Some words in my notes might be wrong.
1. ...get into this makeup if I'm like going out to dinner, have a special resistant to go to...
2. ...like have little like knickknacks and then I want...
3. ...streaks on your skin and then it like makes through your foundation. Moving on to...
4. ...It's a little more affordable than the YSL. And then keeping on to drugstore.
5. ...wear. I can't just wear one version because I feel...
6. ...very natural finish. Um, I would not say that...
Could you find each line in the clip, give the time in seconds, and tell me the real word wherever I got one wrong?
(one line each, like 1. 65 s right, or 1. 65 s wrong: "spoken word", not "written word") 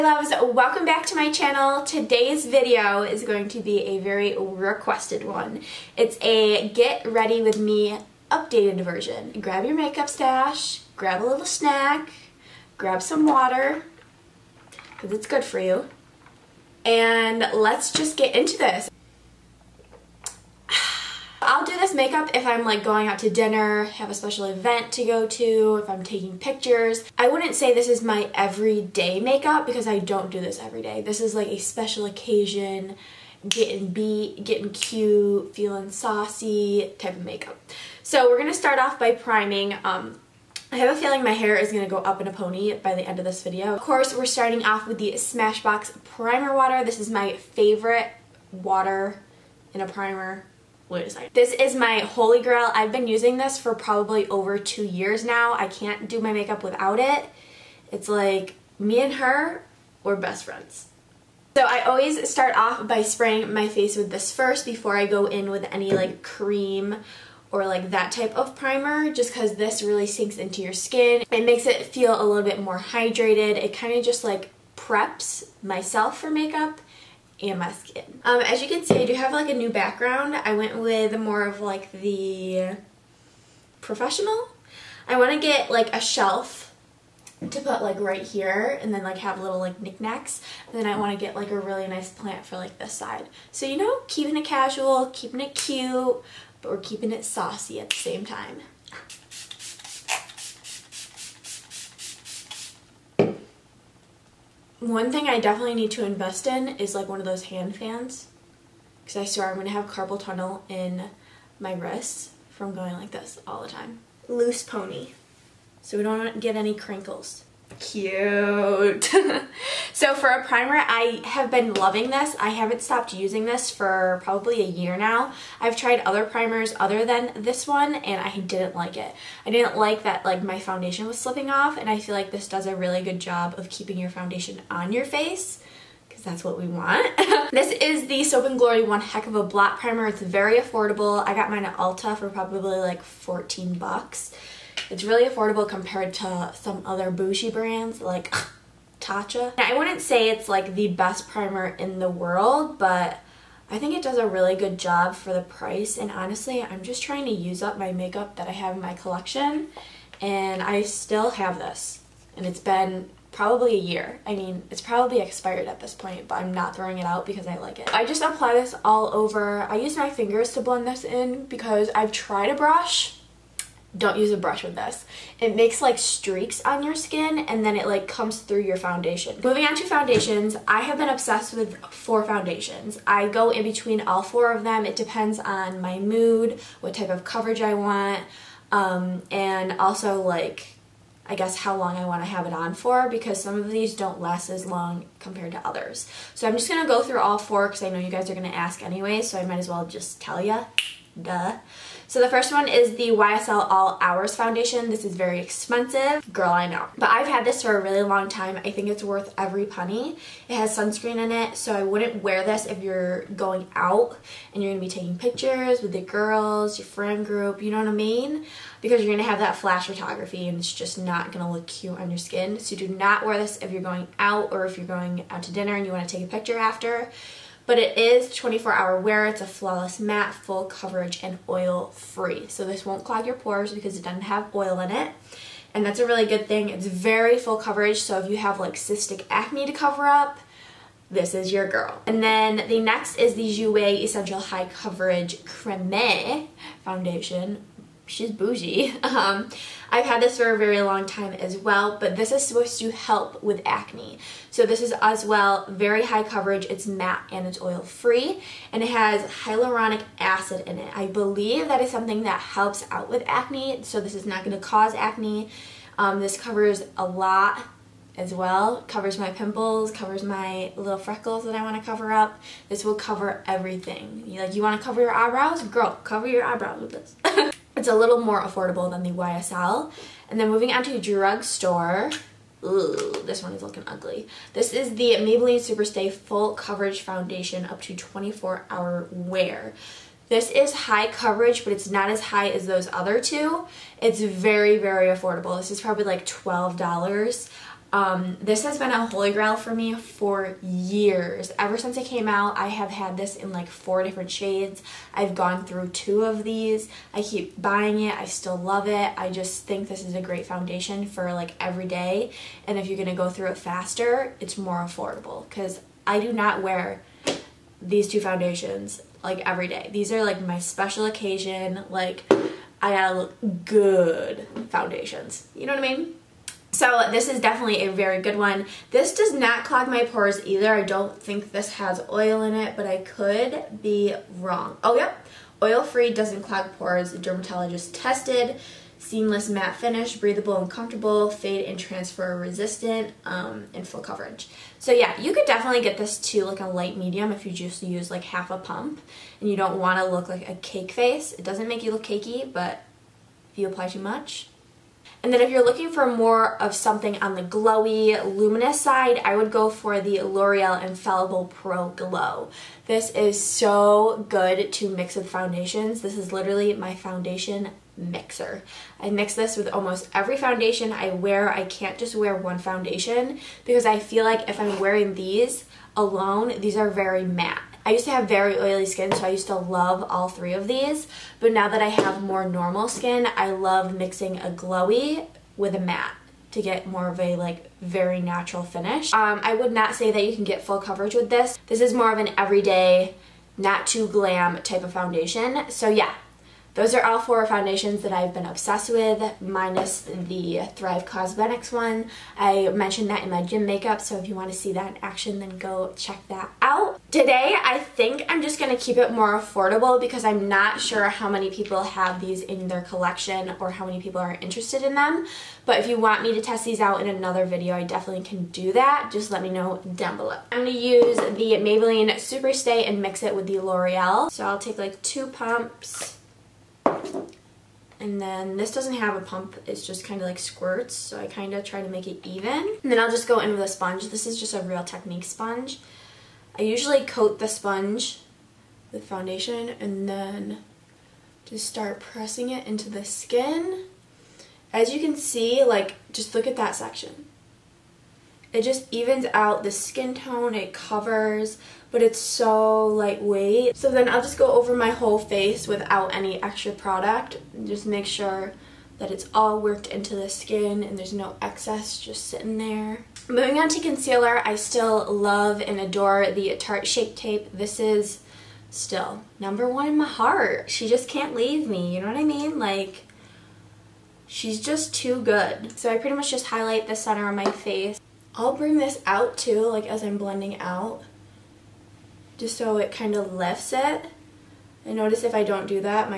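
1. 18 s wrong: "event", not "resistant"
2. 89 s right
3. 175 s wrong: "comes", not "makes"
4. 277 s wrong: "moving", not "keeping"
5. 371 s wrong: "foundation", not "version"
6. 387 s right.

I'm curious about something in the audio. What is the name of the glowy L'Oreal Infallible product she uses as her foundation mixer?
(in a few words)
Pro Glow.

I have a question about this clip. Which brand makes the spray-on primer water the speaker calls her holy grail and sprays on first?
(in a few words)
Smashbox.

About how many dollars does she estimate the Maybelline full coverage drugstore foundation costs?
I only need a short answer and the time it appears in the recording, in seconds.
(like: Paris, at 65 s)
12, at 296 s.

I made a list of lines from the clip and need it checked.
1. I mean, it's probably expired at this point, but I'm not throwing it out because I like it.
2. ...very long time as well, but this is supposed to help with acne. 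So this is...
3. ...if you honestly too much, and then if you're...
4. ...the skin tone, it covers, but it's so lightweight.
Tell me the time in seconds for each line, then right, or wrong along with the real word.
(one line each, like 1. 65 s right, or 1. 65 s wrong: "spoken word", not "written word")
1. 164 s right
2. 250 s right
3. 353 s wrong: "apply", not "honestly"
4. 449 s right.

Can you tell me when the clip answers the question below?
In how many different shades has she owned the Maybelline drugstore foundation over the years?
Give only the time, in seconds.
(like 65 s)
303 s.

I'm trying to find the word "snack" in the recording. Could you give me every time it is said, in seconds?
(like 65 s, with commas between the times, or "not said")
11 s.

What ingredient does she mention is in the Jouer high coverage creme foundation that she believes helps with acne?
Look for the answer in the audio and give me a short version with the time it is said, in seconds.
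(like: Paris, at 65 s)
hyaluronic acid, at 259 s.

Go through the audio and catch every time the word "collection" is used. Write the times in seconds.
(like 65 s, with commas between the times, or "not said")
158 s, 412 s.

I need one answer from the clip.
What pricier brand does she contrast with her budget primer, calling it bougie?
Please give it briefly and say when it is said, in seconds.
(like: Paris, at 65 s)
Tatcha, at 149 s.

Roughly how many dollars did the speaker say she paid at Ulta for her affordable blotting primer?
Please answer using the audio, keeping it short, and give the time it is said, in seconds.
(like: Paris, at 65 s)
14, at 143 s.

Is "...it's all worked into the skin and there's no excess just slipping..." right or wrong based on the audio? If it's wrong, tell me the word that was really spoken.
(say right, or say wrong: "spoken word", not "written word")
wrong: "sitting", not "slipping".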